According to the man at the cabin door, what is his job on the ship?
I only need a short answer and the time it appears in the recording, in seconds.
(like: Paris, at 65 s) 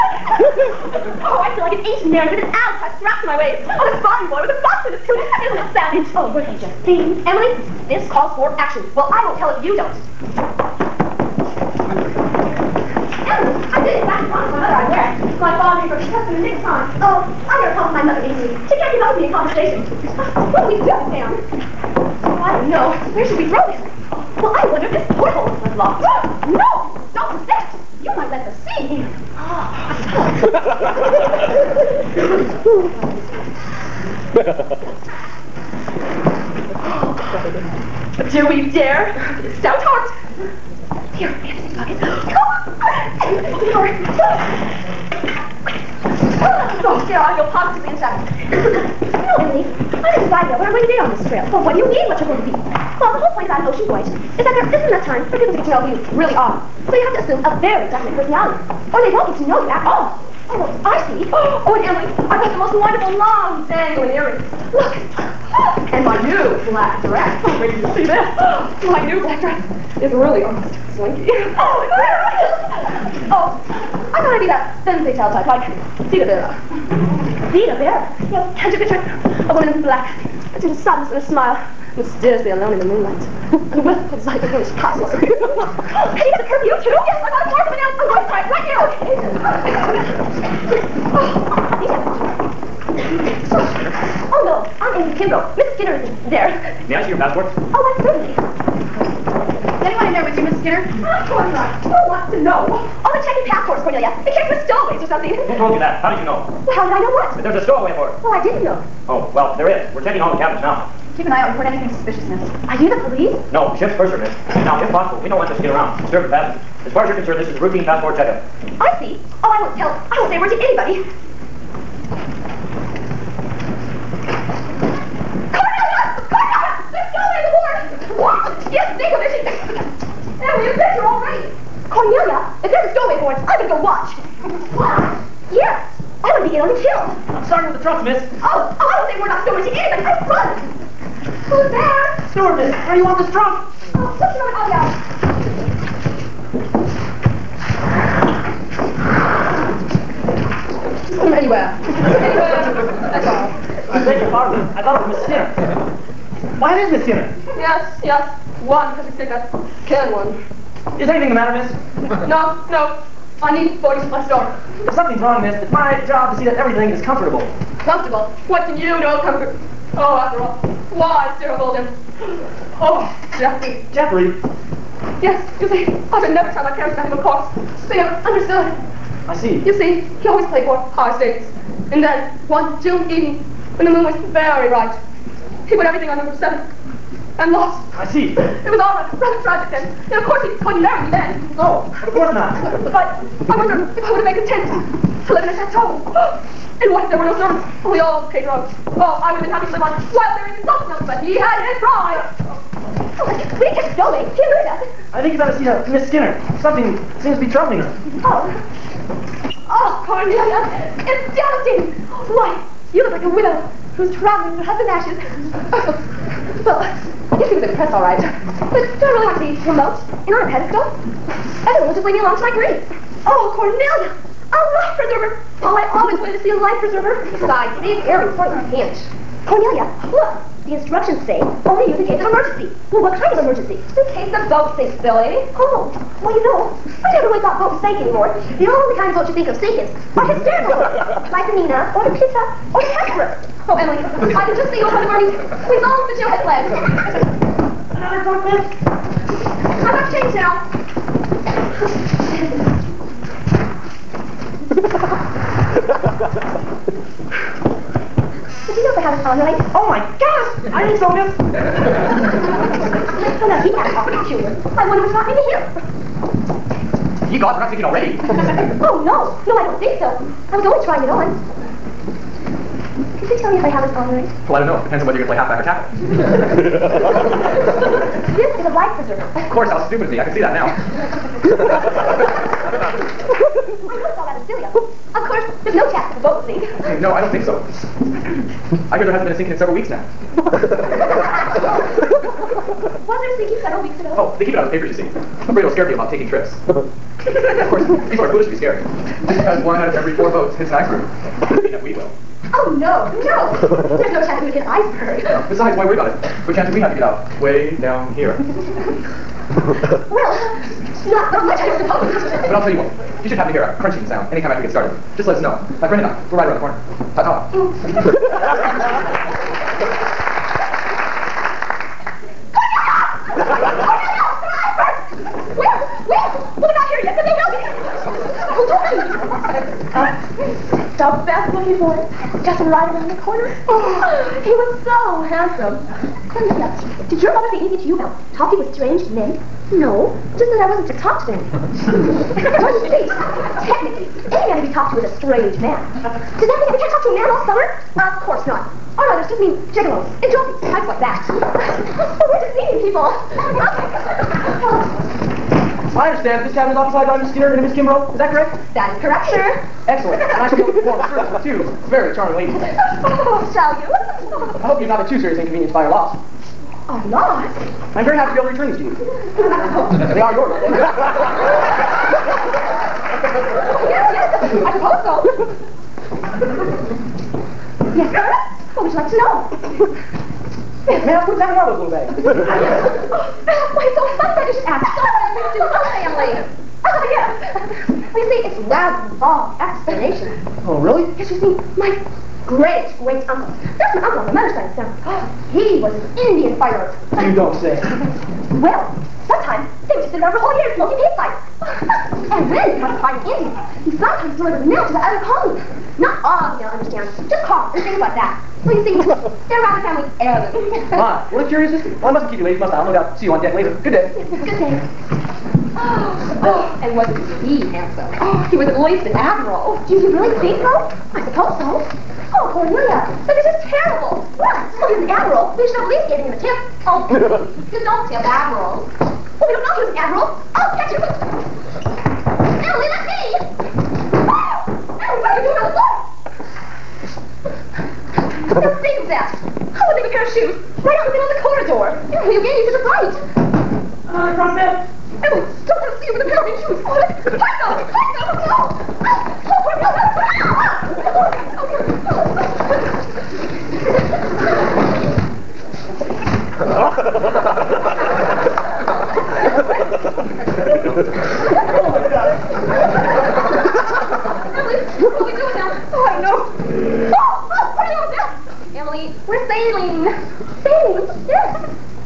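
ship's purser, at 113 s.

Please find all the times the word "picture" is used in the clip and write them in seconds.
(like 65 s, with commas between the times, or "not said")
78 s, 130 s.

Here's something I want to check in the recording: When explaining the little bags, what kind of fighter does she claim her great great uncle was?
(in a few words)
Indian fighter.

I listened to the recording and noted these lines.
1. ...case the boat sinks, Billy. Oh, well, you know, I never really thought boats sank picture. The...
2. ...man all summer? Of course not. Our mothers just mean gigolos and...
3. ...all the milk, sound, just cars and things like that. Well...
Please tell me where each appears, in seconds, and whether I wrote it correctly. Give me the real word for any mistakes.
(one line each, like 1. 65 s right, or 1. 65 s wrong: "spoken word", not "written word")
1. 234 s wrong: "anymore", not "picture"
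2. 347 s right
3. 406 s wrong: "understand", not "sound".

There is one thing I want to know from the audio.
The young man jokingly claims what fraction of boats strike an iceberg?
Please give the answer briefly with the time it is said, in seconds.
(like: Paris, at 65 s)
one out of every four, at 299 s.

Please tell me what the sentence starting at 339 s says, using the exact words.
No, just that I wasn't to talk to them.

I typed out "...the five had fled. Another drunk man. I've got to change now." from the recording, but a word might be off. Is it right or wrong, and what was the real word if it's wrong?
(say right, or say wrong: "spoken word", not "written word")
wrong: "two", not "five".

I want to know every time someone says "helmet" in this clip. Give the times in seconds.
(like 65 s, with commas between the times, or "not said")
not said.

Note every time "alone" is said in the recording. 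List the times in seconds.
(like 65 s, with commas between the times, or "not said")
82 s, 222 s.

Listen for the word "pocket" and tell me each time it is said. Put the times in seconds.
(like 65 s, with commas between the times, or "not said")
41 s.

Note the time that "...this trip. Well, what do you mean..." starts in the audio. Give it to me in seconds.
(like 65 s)
51 s.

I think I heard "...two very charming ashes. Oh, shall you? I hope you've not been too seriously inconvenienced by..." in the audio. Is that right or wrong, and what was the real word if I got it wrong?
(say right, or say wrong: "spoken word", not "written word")
wrong: "ladies", not "ashes".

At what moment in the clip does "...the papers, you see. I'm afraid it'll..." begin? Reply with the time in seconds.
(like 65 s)
294 s.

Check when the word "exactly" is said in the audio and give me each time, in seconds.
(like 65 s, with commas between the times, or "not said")
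381 s.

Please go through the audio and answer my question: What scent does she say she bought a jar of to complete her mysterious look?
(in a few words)
vanilla.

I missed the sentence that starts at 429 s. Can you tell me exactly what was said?
Well, we don't know he was an admiral.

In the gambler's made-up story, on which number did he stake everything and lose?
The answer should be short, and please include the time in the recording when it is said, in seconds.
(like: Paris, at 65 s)
7, at 186 s.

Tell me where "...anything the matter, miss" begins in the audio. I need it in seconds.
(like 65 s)
161 s.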